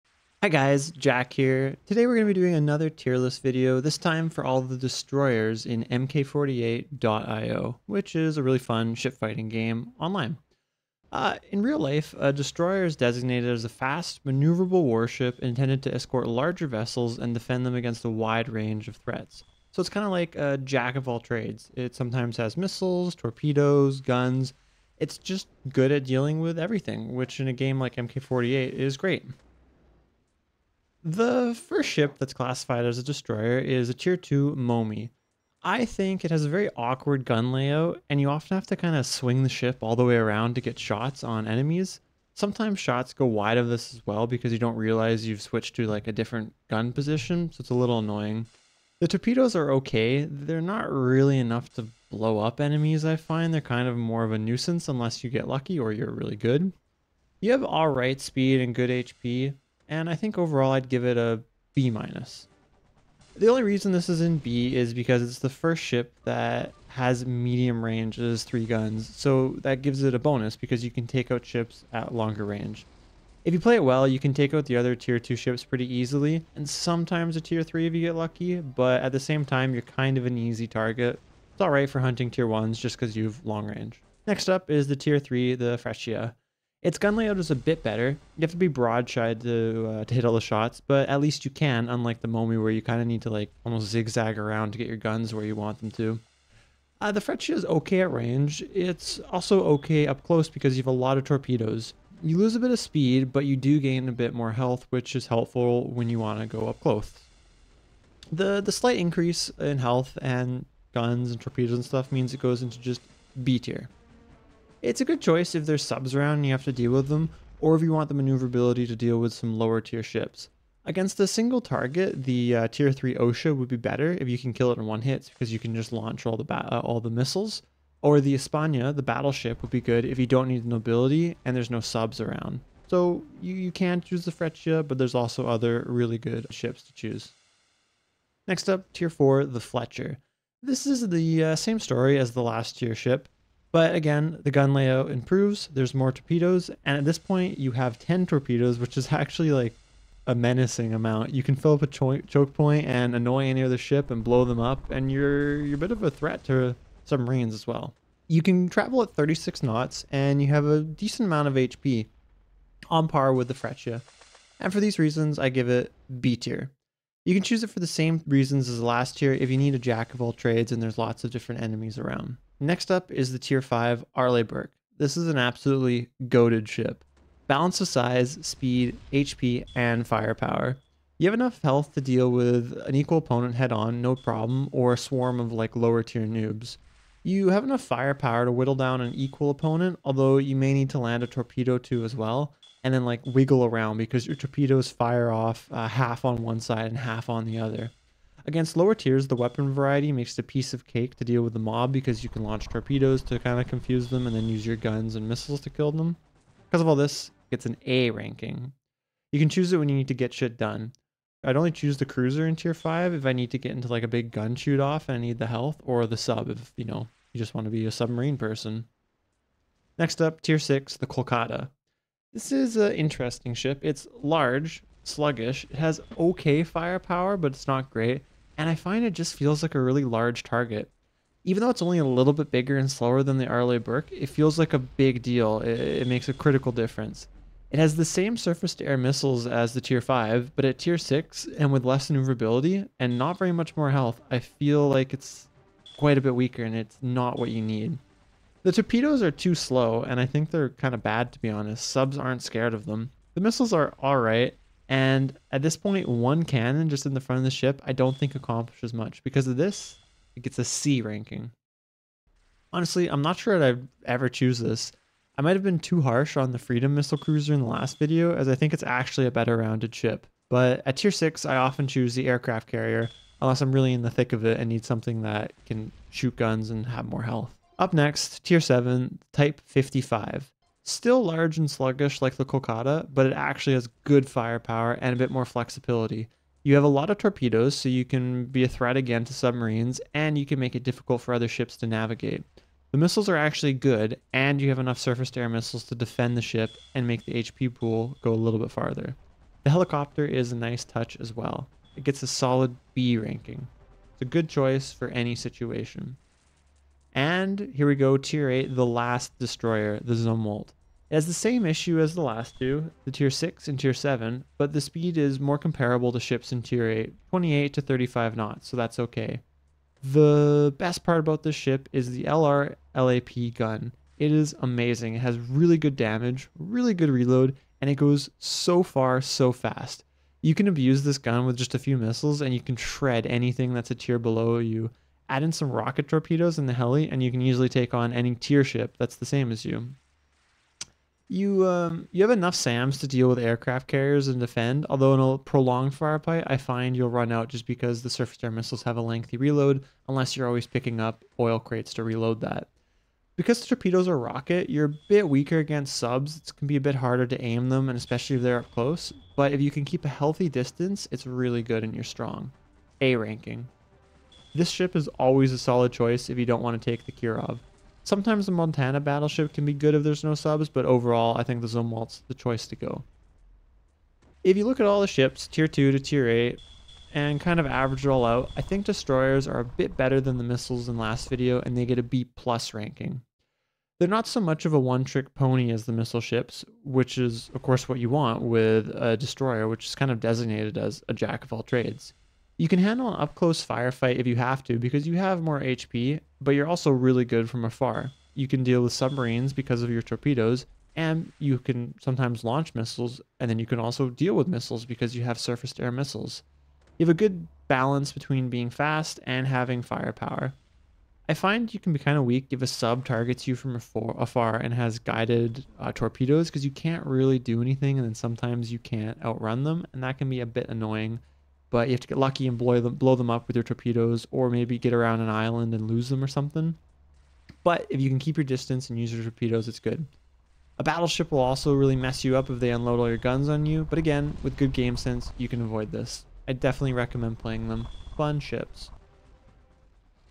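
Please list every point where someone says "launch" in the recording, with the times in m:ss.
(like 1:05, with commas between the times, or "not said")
2:05, 3:22, 6:42.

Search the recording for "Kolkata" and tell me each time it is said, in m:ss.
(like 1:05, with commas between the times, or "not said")
3:41, 4:42.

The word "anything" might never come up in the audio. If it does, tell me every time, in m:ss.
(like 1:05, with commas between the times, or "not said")
5:33, 6:57.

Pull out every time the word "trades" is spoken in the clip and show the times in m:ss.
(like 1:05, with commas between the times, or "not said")
0:21, 2:50, 6:31.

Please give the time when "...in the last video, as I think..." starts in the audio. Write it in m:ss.
4:27.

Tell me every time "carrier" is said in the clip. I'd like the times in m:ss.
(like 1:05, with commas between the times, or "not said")
4:32, 5:43.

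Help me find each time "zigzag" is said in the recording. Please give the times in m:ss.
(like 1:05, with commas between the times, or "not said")
1:33.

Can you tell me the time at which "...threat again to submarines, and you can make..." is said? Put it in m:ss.
4:48.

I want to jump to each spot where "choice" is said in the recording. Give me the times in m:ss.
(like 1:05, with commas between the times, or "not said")
1:55, 5:04, 6:05, 6:12.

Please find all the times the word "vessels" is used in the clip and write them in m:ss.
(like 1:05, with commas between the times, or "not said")
0:16.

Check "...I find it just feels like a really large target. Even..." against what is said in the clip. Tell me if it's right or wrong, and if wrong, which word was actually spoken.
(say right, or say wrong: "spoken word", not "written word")
right.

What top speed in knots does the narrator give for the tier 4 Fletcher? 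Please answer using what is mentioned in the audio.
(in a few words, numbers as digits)
36 knots.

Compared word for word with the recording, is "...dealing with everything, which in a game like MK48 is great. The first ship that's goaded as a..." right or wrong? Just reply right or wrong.
wrong.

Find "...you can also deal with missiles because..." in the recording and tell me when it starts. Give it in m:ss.
6:43.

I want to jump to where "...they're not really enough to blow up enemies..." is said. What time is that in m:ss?
0:50.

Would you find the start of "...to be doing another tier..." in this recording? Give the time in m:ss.
0:02.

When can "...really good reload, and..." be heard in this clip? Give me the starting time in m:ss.
5:26.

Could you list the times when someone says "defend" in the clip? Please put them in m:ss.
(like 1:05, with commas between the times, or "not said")
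0:17, 4:55, 5:44.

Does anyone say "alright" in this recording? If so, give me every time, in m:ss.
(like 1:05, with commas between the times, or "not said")
0:57, 1:21, 4:14.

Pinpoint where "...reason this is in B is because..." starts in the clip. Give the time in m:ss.
1:03.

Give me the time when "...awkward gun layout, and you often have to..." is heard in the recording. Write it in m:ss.
0:36.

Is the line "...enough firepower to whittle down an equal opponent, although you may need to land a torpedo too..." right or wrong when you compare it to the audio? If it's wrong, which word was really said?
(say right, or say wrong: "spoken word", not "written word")
right.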